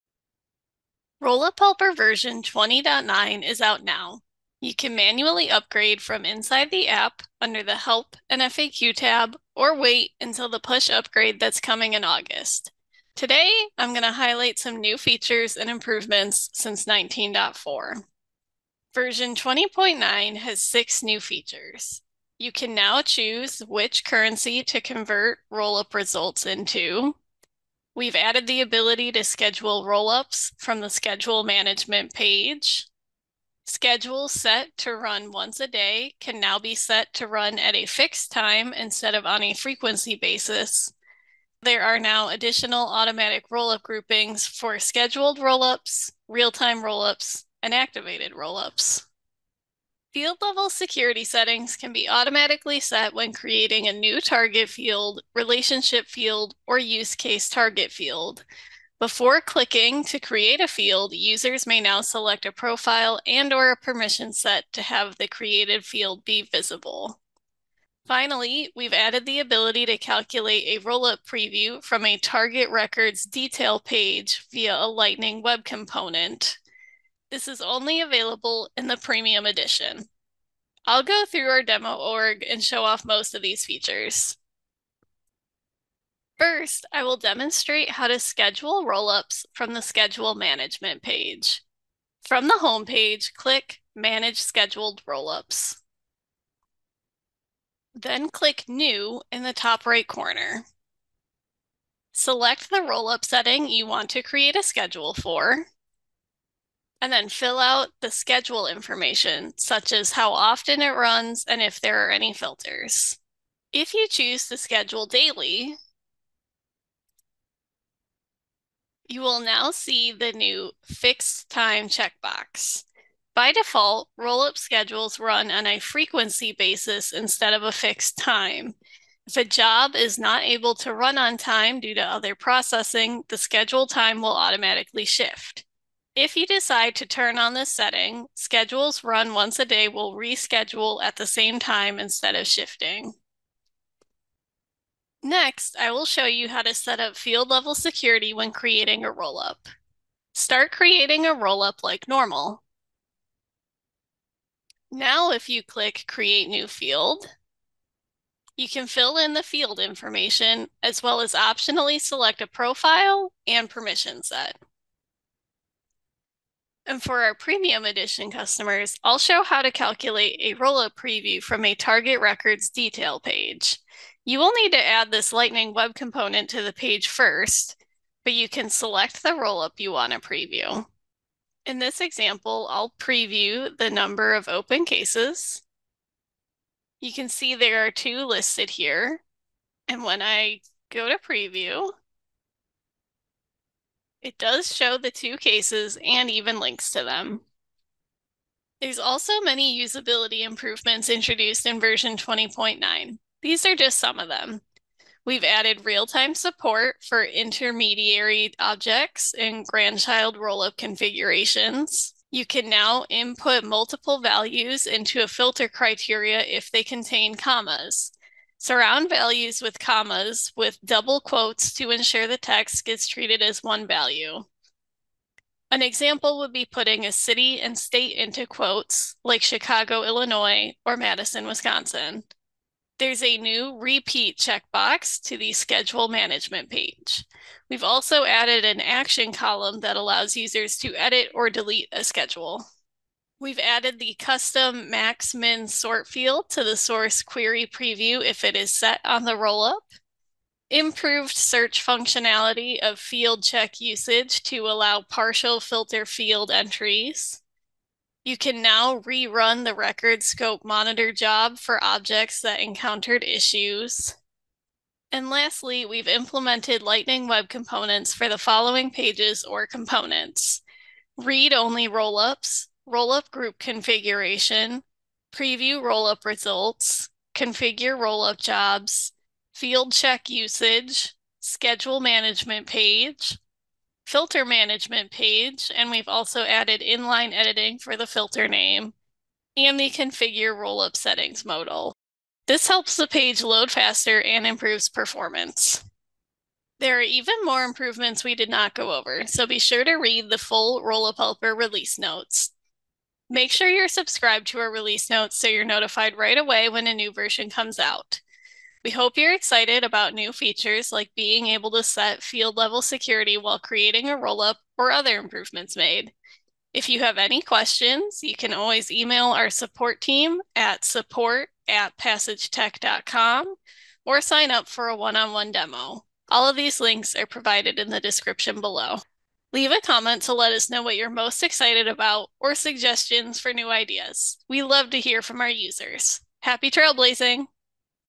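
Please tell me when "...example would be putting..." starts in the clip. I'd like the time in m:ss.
3:45.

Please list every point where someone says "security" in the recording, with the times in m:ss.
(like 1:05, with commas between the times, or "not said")
0:50, 2:27, 5:12.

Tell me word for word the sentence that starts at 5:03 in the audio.
Make sure you're subscribed to our release notes so you're notified right away when a new version comes out.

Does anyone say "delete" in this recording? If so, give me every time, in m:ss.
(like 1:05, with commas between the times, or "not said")
4:01.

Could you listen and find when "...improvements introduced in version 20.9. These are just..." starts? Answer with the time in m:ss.
3:20.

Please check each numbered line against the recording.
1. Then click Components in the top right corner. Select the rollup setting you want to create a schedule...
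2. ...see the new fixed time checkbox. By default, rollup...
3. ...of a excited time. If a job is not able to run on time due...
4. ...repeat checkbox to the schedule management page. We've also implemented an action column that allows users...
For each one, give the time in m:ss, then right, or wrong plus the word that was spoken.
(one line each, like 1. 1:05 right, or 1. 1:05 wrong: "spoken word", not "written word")
1. 1:37 wrong: "New", not "Components"
2. 1:59 right
3. 2:07 wrong: "fixed", not "excited"
4. 3:53 wrong: "added", not "implemented".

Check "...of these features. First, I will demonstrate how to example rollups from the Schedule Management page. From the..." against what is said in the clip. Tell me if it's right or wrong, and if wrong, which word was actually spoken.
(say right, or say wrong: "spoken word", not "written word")
wrong: "schedule", not "example".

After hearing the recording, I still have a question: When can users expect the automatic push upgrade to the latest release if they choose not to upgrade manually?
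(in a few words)
August.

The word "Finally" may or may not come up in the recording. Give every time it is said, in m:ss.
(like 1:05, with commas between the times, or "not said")
1:08.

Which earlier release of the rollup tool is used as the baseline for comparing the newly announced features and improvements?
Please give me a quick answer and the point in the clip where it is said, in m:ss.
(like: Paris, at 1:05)
19.4, at 0:16.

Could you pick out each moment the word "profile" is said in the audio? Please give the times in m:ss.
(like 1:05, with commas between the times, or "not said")
1:02, 2:42.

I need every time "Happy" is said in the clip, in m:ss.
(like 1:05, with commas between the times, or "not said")
5:36.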